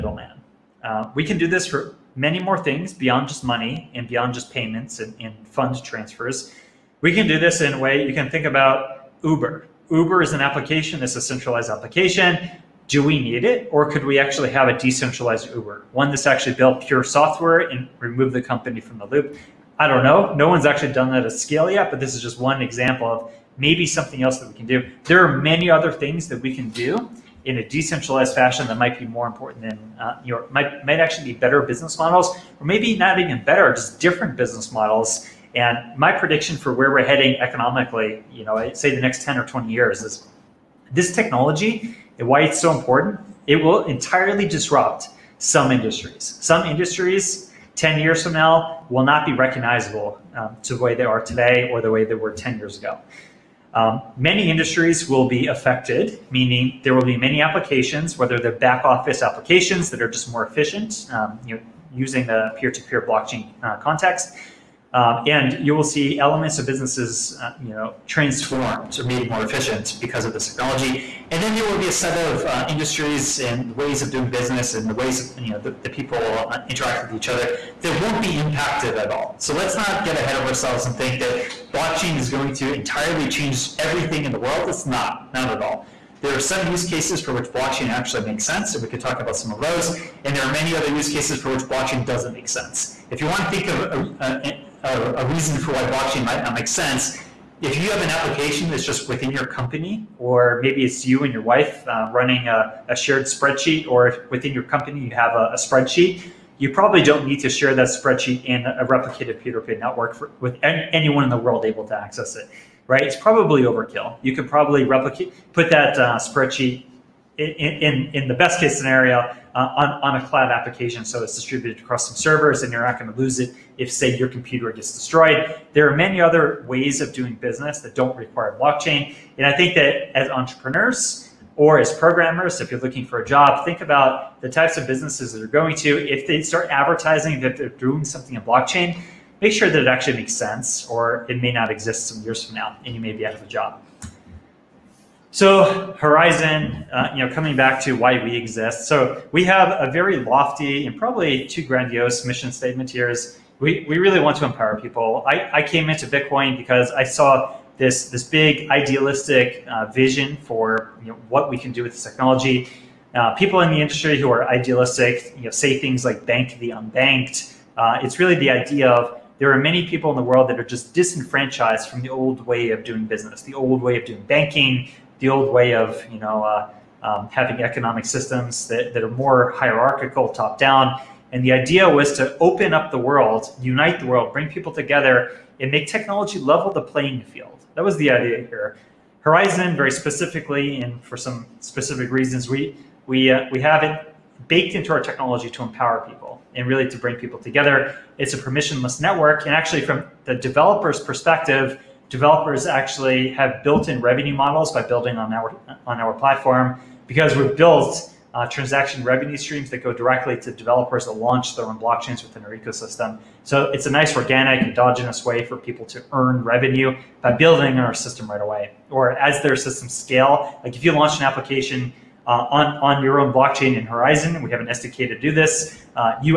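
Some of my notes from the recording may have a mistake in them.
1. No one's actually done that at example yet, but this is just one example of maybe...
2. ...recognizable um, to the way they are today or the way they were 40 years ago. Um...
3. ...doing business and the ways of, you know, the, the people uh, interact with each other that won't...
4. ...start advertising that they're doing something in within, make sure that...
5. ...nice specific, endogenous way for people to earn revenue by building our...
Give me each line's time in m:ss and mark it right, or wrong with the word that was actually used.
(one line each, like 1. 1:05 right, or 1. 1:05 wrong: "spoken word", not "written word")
1. 0:20 wrong: "scale", not "example"
2. 0:49 wrong: "10", not "40"
3. 1:14 right
4. 2:16 wrong: "blockchain", not "within"
5. 3:33 wrong: "organic", not "specific".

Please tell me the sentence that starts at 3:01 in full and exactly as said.
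And the idea was to open up the world, unite the world, bring people together, and make technology level the playing field.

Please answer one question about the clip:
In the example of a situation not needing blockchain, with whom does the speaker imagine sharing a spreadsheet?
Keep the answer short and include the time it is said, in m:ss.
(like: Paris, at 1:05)
your wife, at 1:41.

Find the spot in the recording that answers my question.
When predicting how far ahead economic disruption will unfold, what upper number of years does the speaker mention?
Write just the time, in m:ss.
0:39.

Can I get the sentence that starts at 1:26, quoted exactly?
There are some use cases for which blockchain actually makes sense, and we could talk about some of those.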